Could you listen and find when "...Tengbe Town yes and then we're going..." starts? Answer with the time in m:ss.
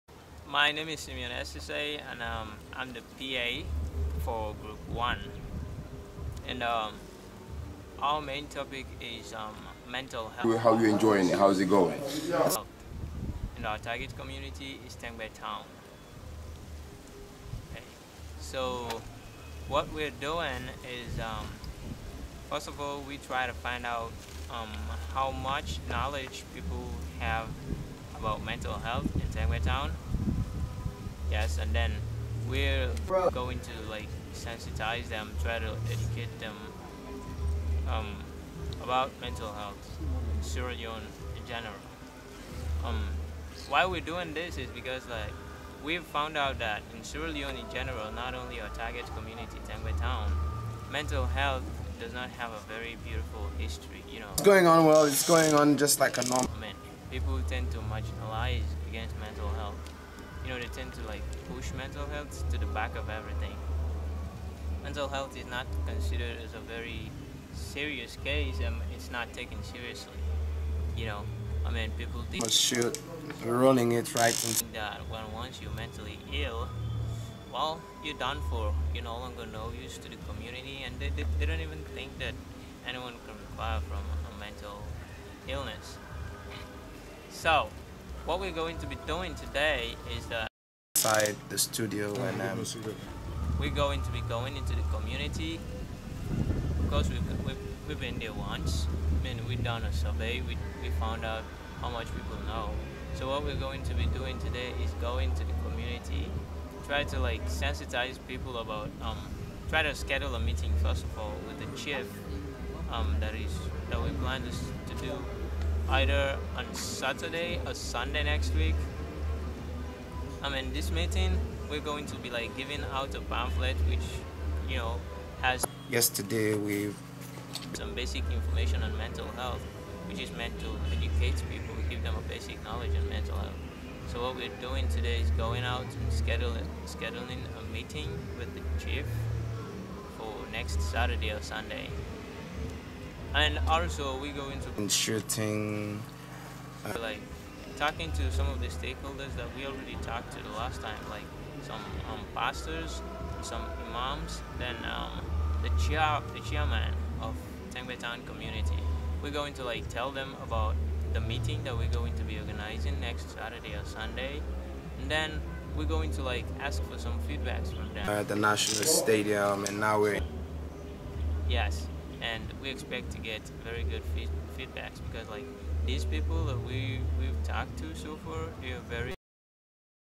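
0:29.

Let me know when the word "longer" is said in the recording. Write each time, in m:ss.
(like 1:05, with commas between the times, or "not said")
1:19.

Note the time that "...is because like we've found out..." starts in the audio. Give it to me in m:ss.
0:44.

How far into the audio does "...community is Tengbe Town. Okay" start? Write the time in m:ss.
0:14.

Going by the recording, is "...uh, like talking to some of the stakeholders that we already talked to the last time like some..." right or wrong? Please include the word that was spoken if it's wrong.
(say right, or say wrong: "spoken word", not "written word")
right.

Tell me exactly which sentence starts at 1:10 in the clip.
You know, I mean, people think.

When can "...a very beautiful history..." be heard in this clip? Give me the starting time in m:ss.
0:52.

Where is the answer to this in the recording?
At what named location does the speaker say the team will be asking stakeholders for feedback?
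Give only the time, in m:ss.
2:48.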